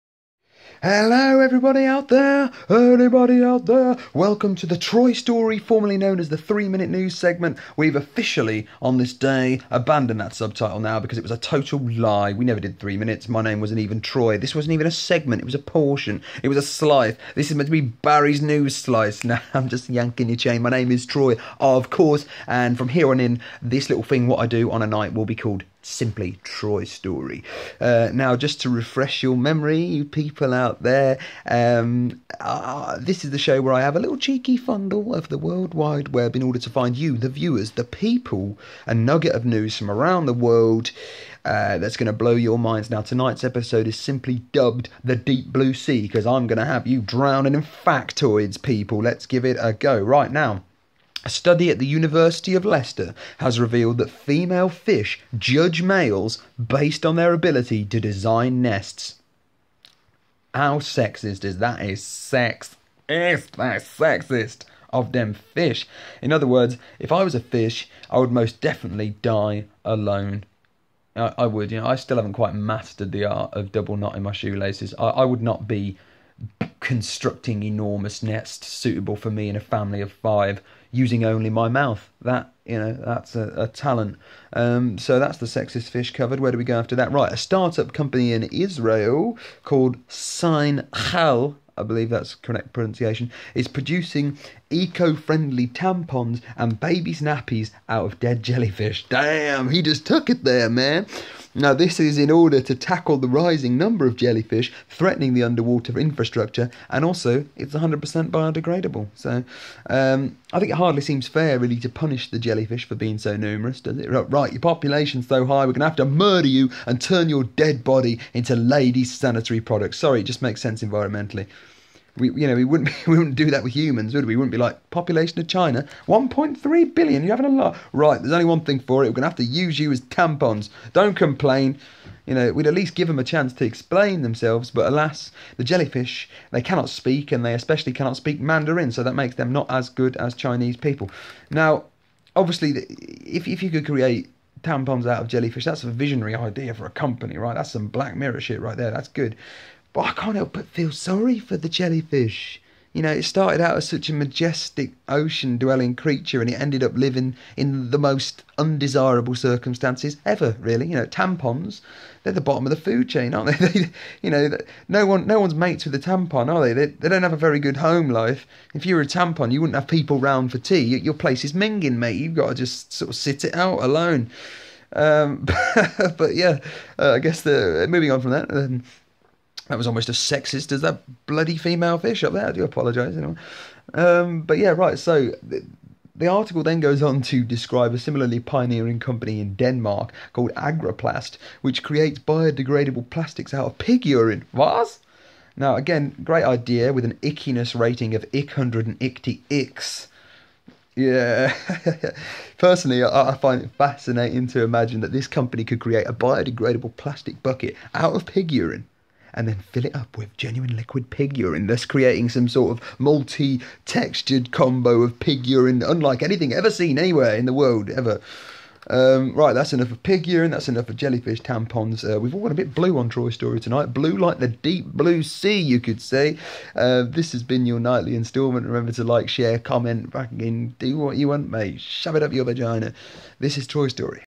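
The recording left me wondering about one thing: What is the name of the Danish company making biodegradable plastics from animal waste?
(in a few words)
Agroplast.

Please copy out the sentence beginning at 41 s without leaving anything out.
Uh, that's going to blow your minds.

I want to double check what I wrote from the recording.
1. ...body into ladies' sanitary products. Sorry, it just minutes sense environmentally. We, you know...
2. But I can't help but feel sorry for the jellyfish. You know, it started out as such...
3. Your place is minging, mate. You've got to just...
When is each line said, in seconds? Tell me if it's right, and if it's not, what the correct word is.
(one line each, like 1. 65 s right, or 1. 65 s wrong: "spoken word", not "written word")
1. 117 s wrong: "makes", not "minutes"
2. 149 s right
3. 170 s right.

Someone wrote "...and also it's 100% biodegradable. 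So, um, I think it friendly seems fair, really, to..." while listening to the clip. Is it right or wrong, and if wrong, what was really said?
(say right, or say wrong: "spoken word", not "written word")
wrong: "hardly", not "friendly".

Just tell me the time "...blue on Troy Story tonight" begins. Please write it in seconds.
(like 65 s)
222 s.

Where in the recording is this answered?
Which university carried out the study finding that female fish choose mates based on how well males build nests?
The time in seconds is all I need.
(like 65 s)
51 s.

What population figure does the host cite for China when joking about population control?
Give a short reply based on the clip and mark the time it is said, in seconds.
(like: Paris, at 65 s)
1.3 billion, at 126 s.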